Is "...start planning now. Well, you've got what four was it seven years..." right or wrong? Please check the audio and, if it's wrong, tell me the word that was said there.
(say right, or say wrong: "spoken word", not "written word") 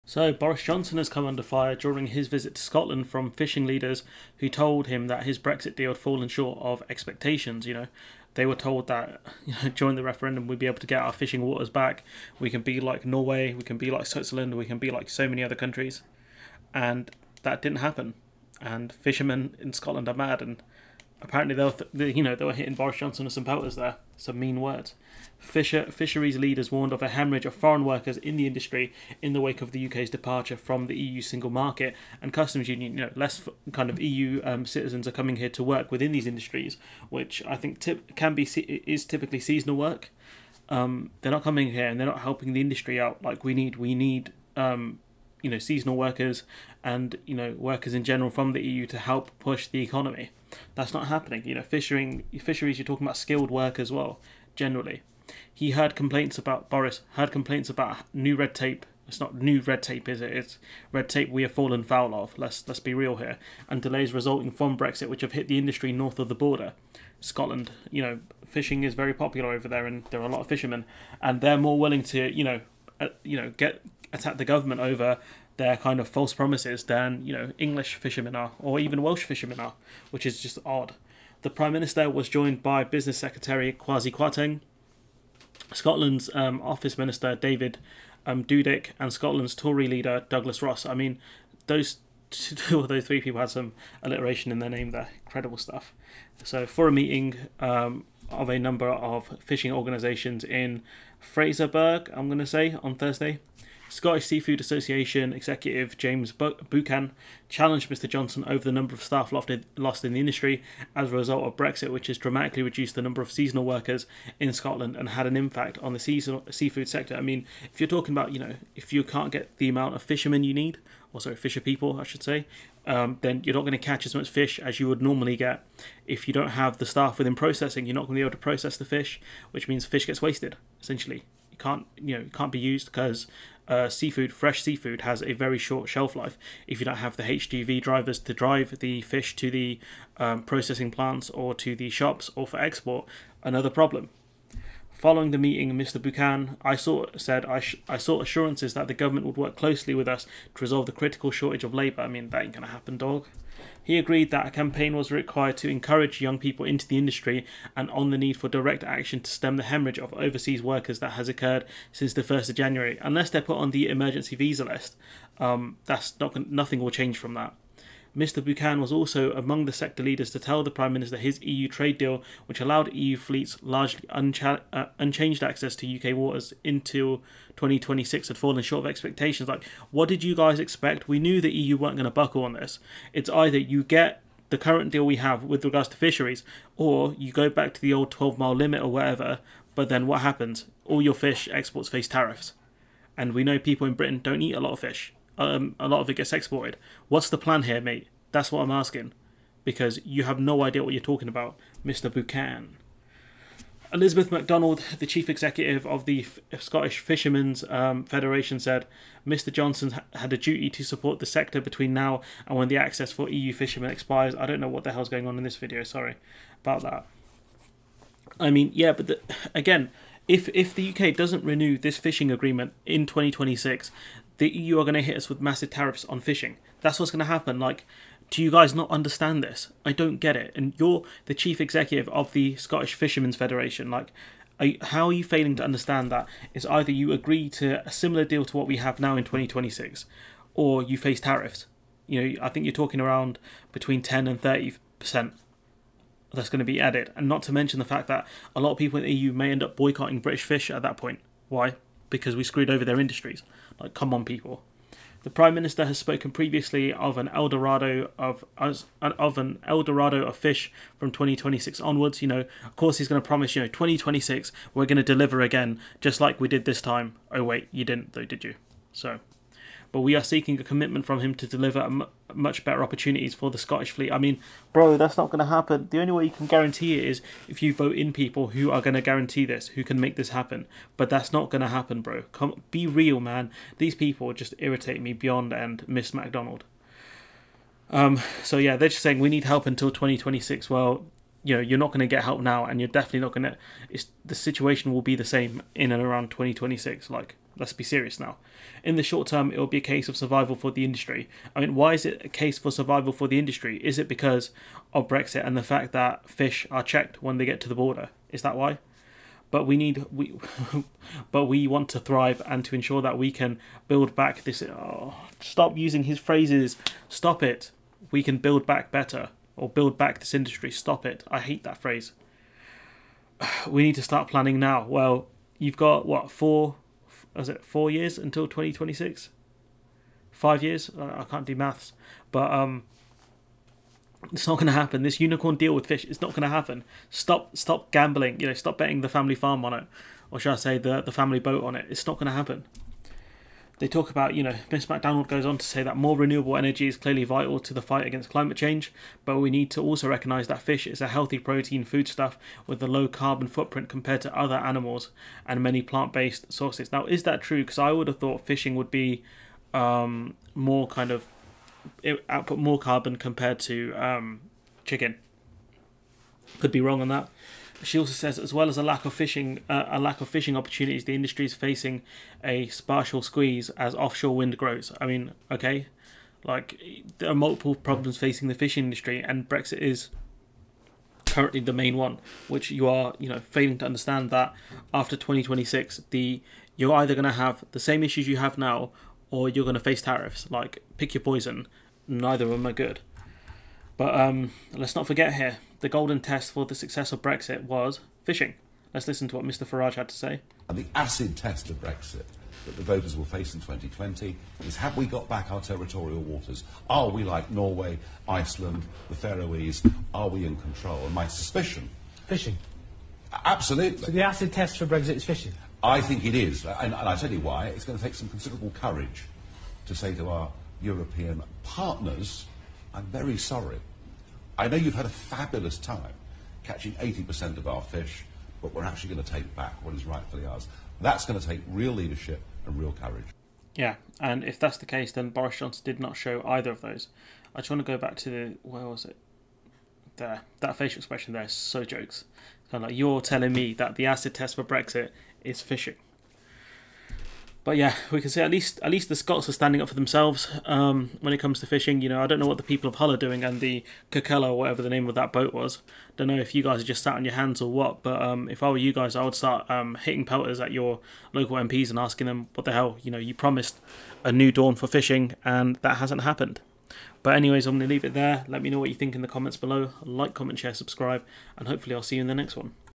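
wrong: "four", not "seven".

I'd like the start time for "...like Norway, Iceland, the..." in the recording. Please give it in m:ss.
6:47.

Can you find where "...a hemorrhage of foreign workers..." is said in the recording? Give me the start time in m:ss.
0:27.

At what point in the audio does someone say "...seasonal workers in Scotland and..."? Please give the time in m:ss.
1:53.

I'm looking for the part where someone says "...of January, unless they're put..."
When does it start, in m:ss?
2:42.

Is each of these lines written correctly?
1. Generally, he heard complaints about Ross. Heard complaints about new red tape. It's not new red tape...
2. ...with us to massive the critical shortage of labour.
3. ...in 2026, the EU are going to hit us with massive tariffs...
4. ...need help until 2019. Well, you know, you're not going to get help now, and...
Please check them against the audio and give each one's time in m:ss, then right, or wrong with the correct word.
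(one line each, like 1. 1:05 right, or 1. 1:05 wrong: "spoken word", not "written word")
1. 0:54 wrong: "Boris", not "Ross"
2. 2:29 wrong: "resolve", not "massive"
3. 3:42 right
4. 4:49 wrong: "2026", not "2019".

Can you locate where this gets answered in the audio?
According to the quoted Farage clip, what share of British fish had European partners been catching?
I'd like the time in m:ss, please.
7:06.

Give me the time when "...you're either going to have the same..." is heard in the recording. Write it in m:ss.
6:26.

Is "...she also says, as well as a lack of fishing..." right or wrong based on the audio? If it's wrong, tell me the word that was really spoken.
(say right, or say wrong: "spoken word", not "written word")
right.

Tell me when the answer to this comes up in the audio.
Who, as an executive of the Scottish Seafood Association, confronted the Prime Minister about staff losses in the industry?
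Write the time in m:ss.
1:45.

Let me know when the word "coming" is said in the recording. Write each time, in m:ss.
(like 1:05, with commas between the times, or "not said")
0:35, 0:41.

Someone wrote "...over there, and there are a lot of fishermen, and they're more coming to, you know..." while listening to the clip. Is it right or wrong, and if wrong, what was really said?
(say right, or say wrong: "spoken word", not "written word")
wrong: "willing", not "coming".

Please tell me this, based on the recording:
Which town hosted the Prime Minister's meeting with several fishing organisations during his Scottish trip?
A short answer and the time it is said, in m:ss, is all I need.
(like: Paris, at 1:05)
Fraserburgh, at 1:41.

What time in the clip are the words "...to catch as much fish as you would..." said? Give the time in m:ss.
2:03.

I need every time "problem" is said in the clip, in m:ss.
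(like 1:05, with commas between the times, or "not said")
2:23, 6:17.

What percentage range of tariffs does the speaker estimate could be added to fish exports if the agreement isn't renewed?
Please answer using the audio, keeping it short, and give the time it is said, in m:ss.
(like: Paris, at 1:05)
10 to 30 percent, at 4:04.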